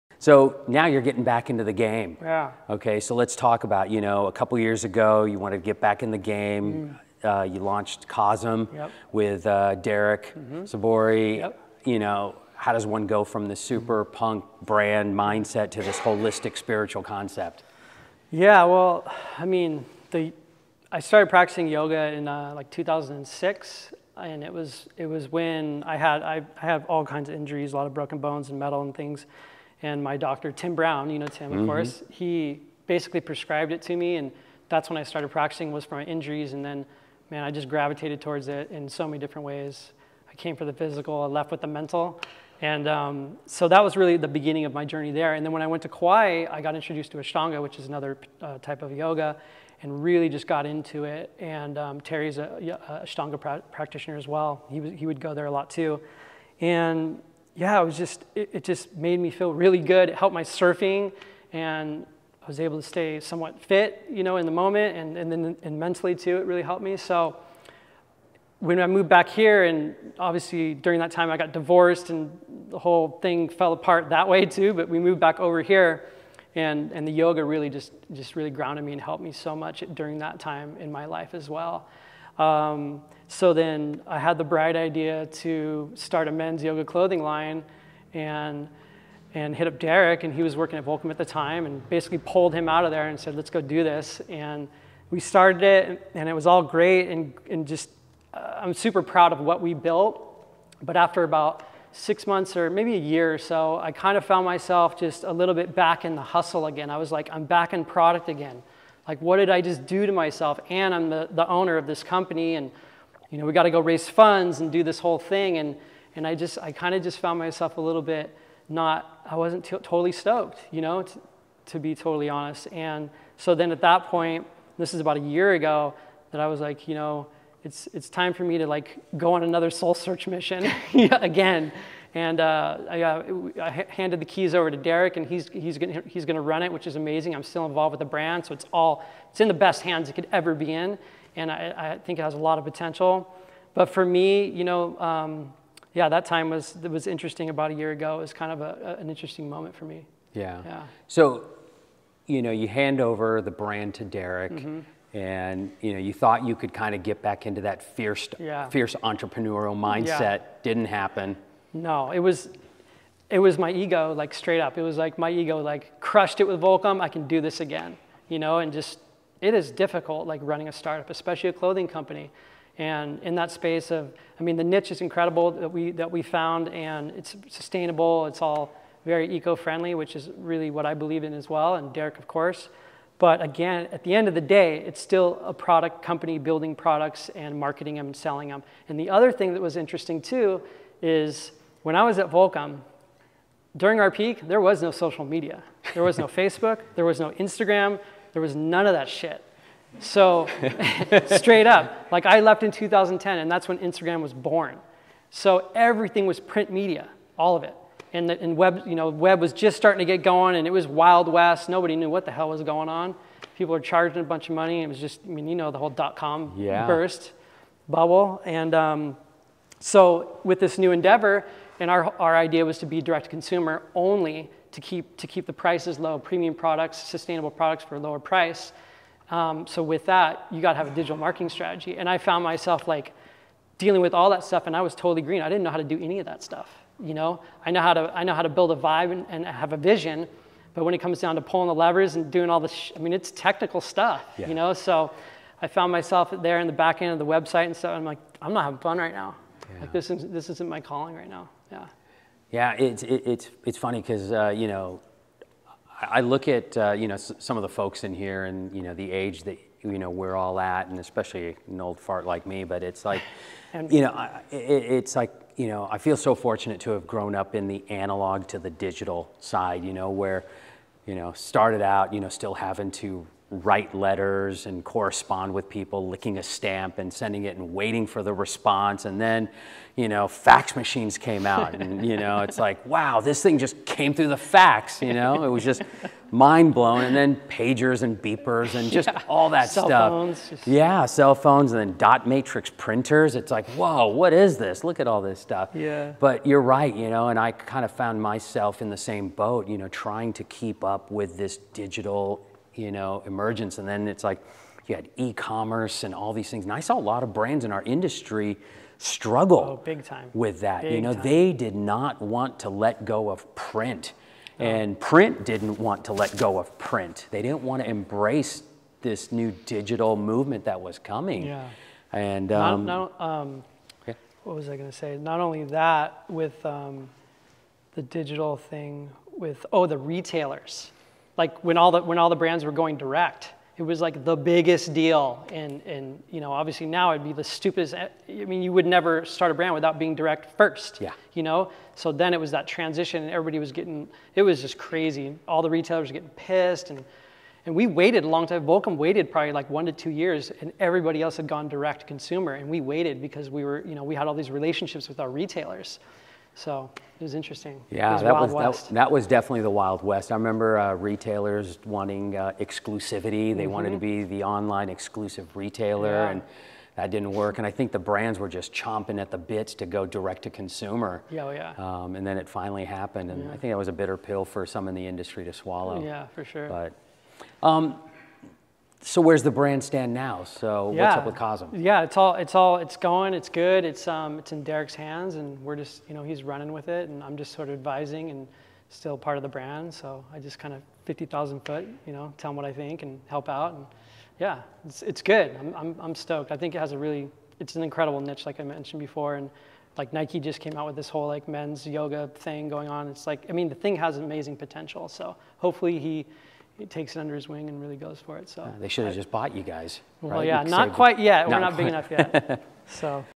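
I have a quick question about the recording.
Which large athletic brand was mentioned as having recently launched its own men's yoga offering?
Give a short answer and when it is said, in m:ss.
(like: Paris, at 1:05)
Nike, at 6:40.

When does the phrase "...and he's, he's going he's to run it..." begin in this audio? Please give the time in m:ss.
2:15.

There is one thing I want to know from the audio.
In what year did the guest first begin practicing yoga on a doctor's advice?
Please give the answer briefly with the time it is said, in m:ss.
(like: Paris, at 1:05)
2006, at 0:22.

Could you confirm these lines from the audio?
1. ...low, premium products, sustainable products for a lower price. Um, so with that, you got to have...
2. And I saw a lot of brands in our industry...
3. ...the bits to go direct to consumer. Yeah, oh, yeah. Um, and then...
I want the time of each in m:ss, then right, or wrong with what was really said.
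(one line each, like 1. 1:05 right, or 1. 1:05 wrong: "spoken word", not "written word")
1. 3:45 right
2. 5:06 right
3. 6:09 right.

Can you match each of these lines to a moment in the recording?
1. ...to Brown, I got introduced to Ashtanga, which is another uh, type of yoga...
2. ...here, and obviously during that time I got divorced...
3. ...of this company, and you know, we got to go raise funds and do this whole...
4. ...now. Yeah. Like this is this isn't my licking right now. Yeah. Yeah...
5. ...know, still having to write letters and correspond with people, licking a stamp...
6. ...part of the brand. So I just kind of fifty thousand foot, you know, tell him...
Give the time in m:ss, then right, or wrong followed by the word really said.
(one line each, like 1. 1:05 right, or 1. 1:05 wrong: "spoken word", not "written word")
1. 0:45 wrong: "Kauai", not "Brown"
2. 1:09 right
3. 1:51 right
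4. 4:09 wrong: "calling", not "licking"
5. 4:32 right
6. 6:29 right.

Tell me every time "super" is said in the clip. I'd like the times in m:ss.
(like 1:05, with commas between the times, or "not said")
0:13, 1:38.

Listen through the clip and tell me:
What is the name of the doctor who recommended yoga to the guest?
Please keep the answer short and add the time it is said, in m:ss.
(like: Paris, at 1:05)
Tim Brown, at 0:30.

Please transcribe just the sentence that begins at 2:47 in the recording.
I can do this again, you know, and just it is difficult, like running a startup, especially a clothing company.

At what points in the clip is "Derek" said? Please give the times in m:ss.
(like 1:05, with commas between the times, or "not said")
0:09, 1:29, 2:14, 2:34, 3:01, 6:24.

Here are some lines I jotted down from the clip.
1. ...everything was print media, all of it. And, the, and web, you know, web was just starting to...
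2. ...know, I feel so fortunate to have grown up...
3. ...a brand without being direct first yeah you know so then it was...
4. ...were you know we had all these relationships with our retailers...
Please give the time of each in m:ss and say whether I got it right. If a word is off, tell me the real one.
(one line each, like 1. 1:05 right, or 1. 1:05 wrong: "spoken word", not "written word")
1. 3:25 right
2. 4:25 right
3. 5:39 right
4. 5:53 right.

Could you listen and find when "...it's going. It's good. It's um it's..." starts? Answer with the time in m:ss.
6:22.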